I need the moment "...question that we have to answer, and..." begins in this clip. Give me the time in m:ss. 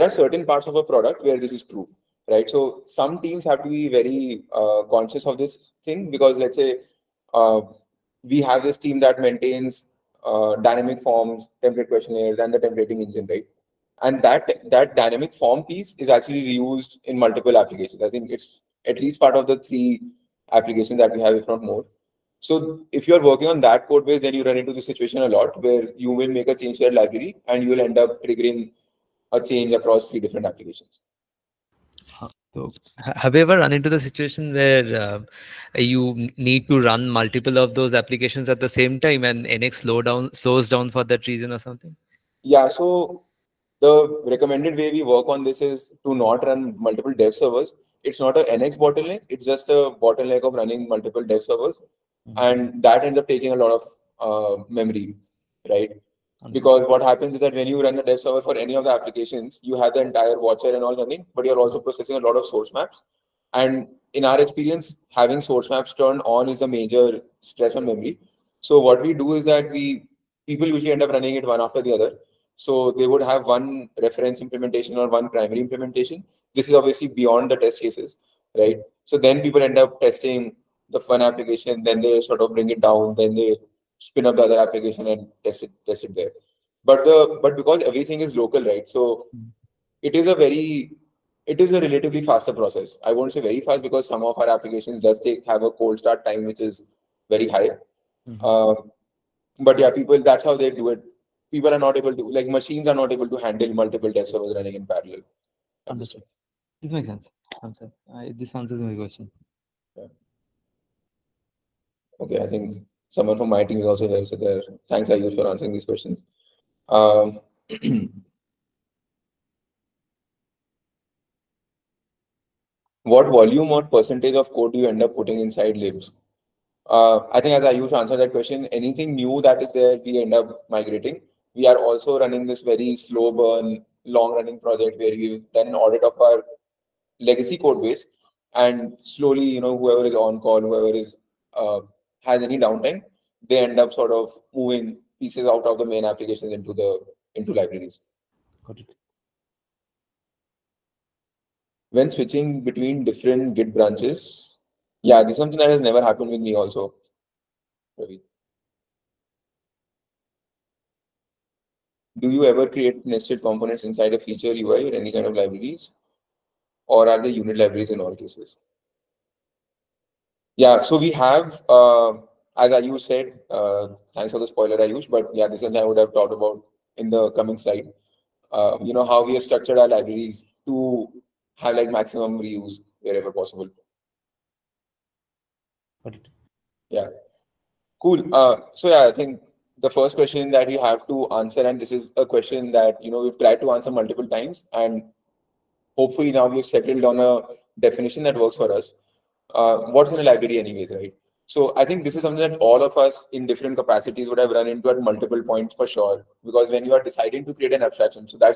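3:10.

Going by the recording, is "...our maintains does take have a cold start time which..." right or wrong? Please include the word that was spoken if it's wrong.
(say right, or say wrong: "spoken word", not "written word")
wrong: "applications", not "maintains".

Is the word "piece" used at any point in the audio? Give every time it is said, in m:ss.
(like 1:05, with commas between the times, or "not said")
0:15, 2:25.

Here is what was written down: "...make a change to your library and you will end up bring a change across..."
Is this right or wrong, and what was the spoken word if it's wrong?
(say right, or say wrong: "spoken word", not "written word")
wrong: "triggering", not "bring".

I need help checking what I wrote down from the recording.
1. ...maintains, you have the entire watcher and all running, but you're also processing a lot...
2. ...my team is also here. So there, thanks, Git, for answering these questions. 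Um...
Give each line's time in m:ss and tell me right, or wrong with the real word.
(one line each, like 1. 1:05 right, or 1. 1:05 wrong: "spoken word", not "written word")
1. 0:58 wrong: "applications", not "maintains"
2. 1:53 wrong: "Ayush", not "Git".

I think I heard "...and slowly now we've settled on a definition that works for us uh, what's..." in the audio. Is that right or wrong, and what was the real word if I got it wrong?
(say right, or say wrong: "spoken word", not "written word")
wrong: "hopefully", not "slowly".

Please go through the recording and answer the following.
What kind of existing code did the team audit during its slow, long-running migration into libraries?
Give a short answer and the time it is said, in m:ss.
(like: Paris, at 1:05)
legacy code base, at 2:17.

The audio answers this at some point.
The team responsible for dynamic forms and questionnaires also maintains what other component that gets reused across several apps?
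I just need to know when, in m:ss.
0:12.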